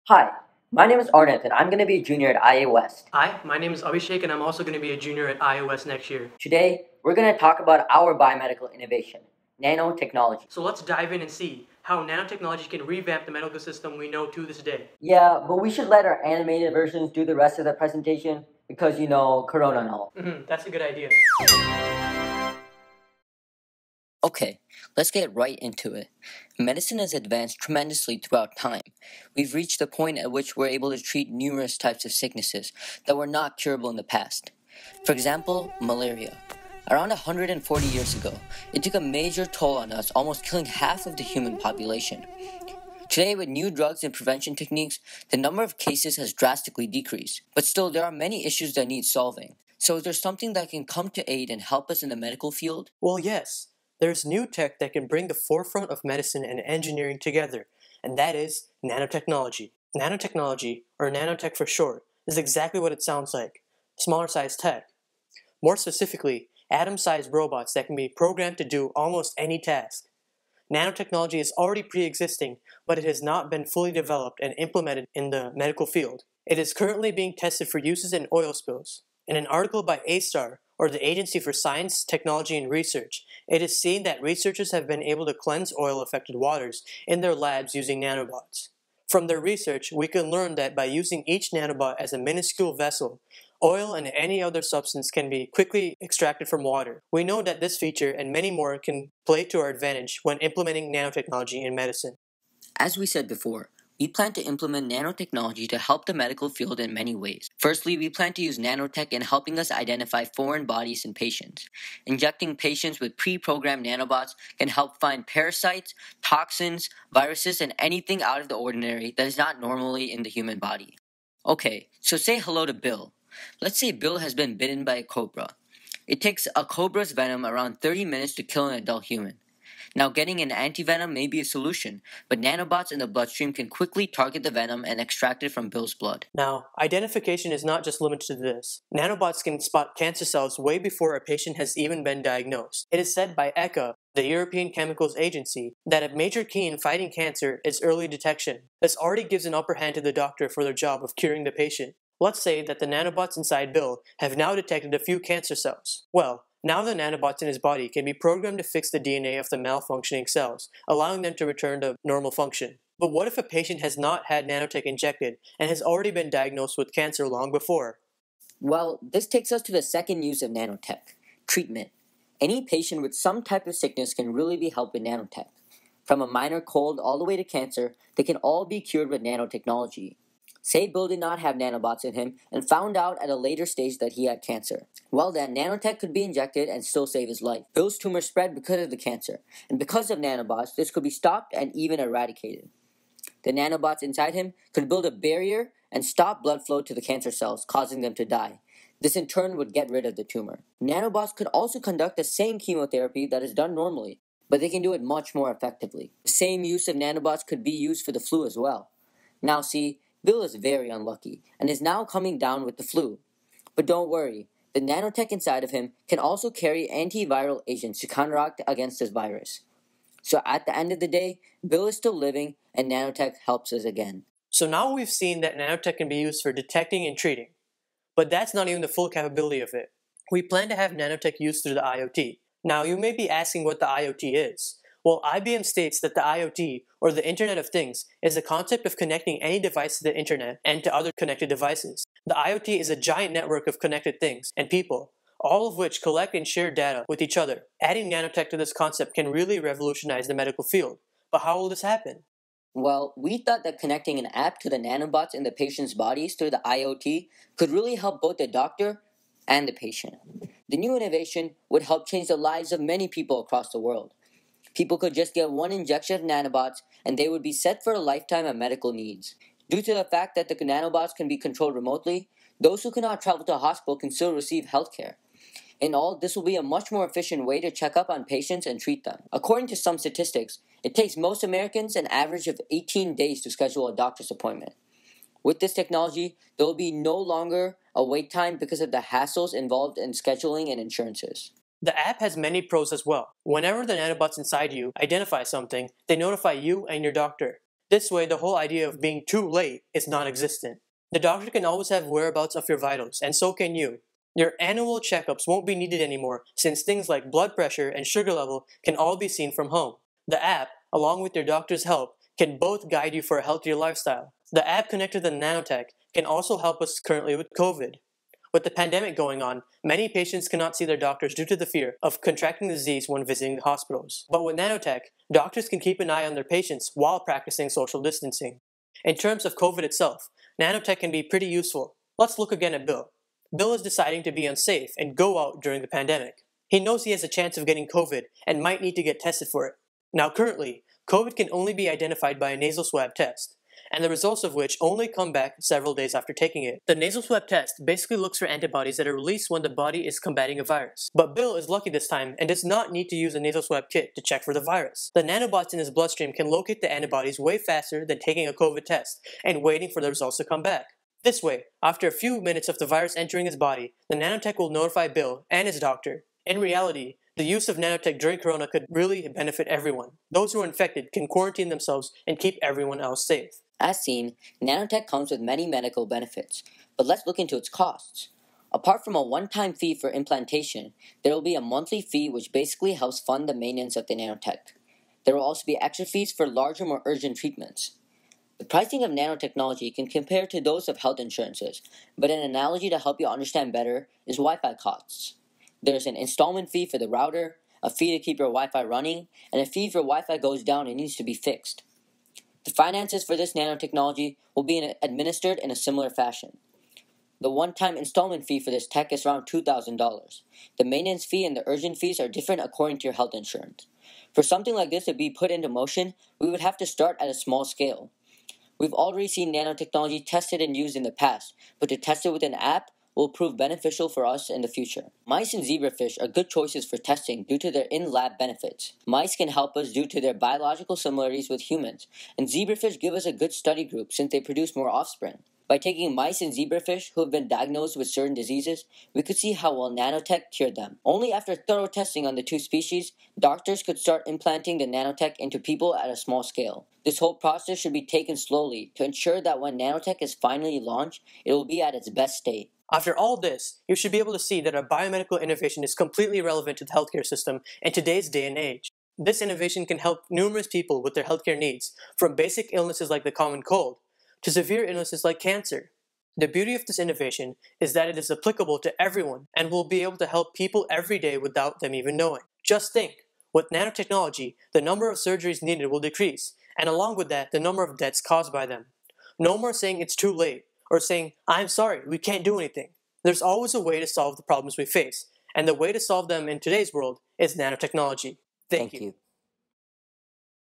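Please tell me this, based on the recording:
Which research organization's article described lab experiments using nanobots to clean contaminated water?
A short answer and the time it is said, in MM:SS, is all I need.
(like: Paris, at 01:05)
A*STAR, at 01:20.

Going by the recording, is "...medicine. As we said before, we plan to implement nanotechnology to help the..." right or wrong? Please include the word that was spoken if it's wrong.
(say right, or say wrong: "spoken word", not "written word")
right.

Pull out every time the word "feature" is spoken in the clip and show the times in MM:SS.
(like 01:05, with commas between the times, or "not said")
01:37.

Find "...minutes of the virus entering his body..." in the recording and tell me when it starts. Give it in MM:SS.
06:02.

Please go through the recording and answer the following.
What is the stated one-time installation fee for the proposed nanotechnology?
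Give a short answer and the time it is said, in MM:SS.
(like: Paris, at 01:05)
$2,000, at 06:49.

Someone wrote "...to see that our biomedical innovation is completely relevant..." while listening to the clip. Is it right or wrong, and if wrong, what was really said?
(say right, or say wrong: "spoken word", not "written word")
right.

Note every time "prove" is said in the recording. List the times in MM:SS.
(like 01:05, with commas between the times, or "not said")
07:03.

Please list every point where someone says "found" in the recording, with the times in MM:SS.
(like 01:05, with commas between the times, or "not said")
03:02.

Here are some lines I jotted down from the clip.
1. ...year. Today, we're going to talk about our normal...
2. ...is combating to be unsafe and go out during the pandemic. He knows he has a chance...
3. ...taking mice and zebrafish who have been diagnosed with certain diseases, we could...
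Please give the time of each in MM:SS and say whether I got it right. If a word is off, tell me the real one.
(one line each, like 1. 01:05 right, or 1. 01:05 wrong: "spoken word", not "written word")
1. 00:06 wrong: "biomedical", not "normal"
2. 05:33 wrong: "deciding", not "combating"
3. 07:15 right.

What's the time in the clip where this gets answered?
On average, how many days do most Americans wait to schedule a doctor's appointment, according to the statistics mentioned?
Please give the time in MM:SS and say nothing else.
04:42.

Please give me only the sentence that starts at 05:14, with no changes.
The app connected to Nanotech can also help us currently with COVID.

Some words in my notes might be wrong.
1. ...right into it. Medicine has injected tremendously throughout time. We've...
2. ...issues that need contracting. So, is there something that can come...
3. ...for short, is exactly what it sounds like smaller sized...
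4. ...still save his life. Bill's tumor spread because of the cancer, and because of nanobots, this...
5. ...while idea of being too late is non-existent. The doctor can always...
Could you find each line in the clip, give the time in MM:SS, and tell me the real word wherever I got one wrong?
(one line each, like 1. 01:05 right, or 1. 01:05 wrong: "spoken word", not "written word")
1. 00:25 wrong: "advanced", not "injected"
2. 00:48 wrong: "solving", not "contracting"
3. 01:01 right
4. 03:06 right
5. 04:58 wrong: "whole", not "while".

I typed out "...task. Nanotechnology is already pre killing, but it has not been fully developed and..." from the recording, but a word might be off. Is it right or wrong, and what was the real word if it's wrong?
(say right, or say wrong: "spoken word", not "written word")
wrong: "existing", not "killing".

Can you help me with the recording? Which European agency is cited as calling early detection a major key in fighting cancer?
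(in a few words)
European Chemicals Agency.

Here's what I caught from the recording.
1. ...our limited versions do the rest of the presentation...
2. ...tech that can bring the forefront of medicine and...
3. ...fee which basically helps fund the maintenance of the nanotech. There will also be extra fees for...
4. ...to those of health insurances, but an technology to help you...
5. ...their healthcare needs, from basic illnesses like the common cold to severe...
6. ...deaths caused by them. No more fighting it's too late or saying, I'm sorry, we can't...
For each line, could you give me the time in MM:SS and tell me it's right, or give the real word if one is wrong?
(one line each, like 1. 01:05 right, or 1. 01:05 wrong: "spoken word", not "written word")
1. 00:16 wrong: "animated", not "limited"
2. 00:54 right
3. 06:21 right
4. 06:30 wrong: "analogy", not "technology"
5. 07:41 right
6. 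07:57 wrong: "saying", not "fighting".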